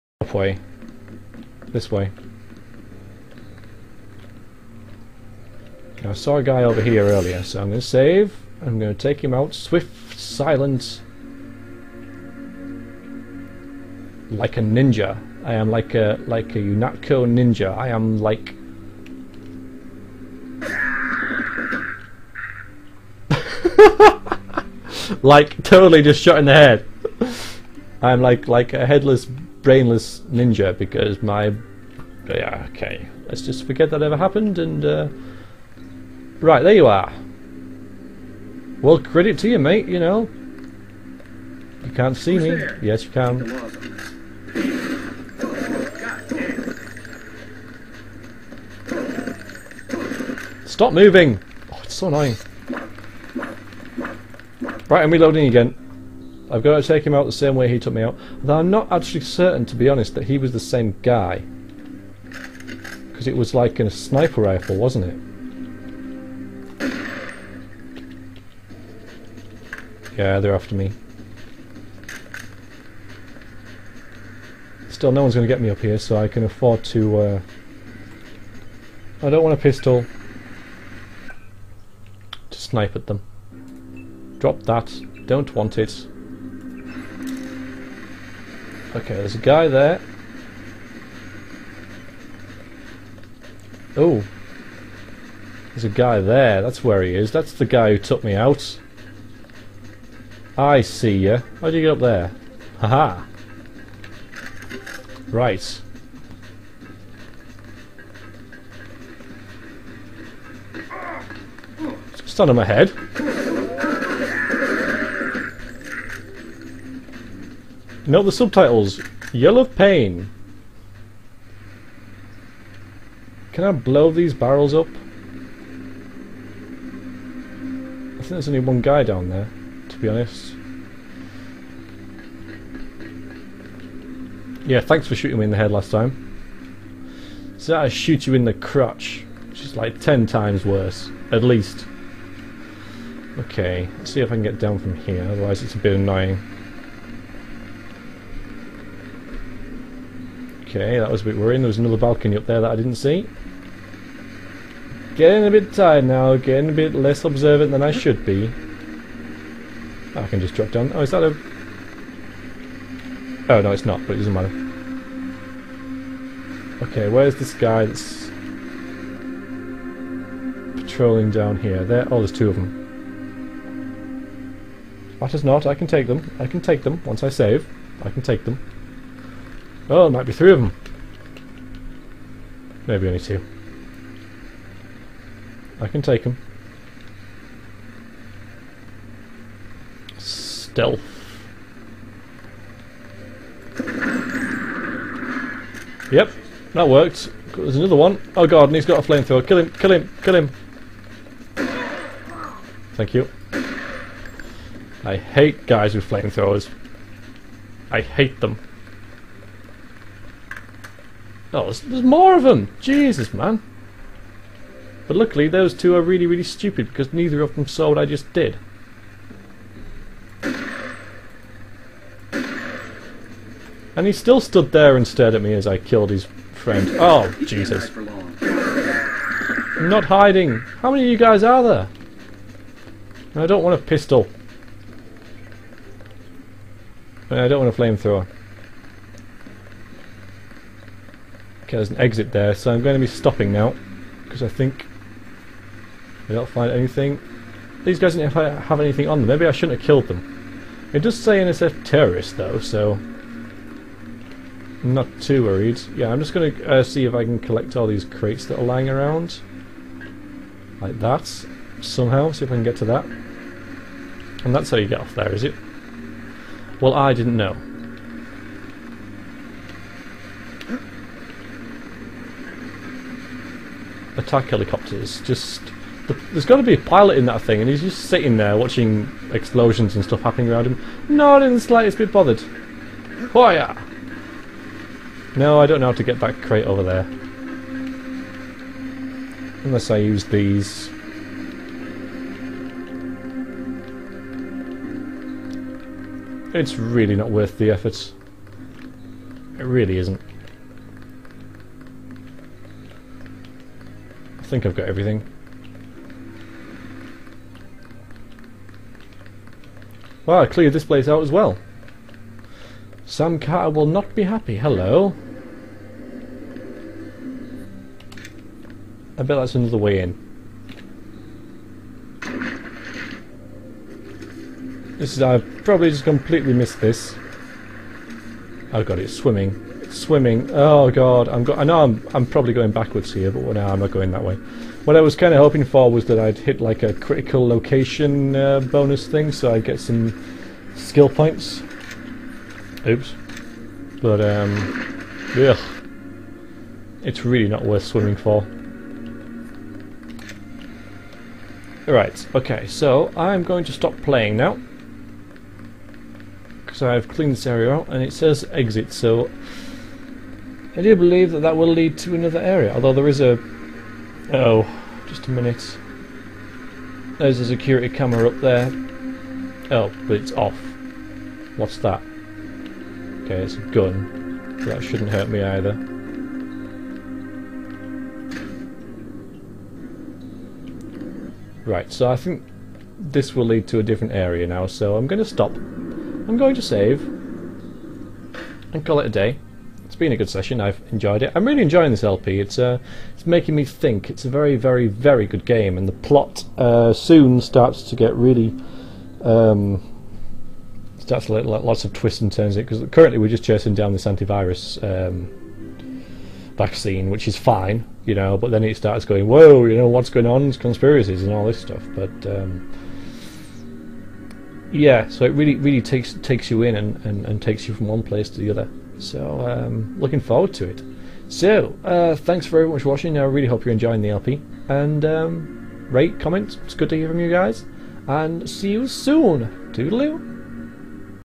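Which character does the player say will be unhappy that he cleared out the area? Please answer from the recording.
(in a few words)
Sam Carter.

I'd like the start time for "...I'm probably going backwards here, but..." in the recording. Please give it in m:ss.
5:32.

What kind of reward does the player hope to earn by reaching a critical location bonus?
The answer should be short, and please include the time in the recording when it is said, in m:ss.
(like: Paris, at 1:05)
Skill points, at 5:40.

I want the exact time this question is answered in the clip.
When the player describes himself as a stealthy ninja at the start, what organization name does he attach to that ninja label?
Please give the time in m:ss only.
0:16.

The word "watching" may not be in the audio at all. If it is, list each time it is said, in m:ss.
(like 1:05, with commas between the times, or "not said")
4:38, 7:02.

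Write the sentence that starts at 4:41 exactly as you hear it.
Not in the slightest bit bothered.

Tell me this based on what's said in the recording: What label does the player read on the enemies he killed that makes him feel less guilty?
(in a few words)
NSF terrorist.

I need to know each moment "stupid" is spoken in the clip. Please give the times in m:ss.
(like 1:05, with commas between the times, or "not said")
3:36.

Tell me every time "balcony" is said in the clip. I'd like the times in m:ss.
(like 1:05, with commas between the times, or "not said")
2:31.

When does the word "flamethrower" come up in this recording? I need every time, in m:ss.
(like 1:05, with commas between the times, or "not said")
3:19, 3:26, 3:57.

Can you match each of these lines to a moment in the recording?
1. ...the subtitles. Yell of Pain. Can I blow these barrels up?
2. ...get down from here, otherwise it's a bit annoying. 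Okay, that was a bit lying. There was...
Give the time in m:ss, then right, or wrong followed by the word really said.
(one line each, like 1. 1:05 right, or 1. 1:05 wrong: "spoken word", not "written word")
1. 1:58 right
2. 2:24 wrong: "worrying", not "lying".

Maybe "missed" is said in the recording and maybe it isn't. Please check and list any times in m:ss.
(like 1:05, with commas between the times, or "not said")
5:26.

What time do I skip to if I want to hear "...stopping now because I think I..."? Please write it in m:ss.
4:03.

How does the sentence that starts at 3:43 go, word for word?
And he still stood there and stared at me as I killed his friend.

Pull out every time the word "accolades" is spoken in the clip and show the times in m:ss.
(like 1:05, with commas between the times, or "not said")
not said.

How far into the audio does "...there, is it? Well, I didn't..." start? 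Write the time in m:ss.
4:25.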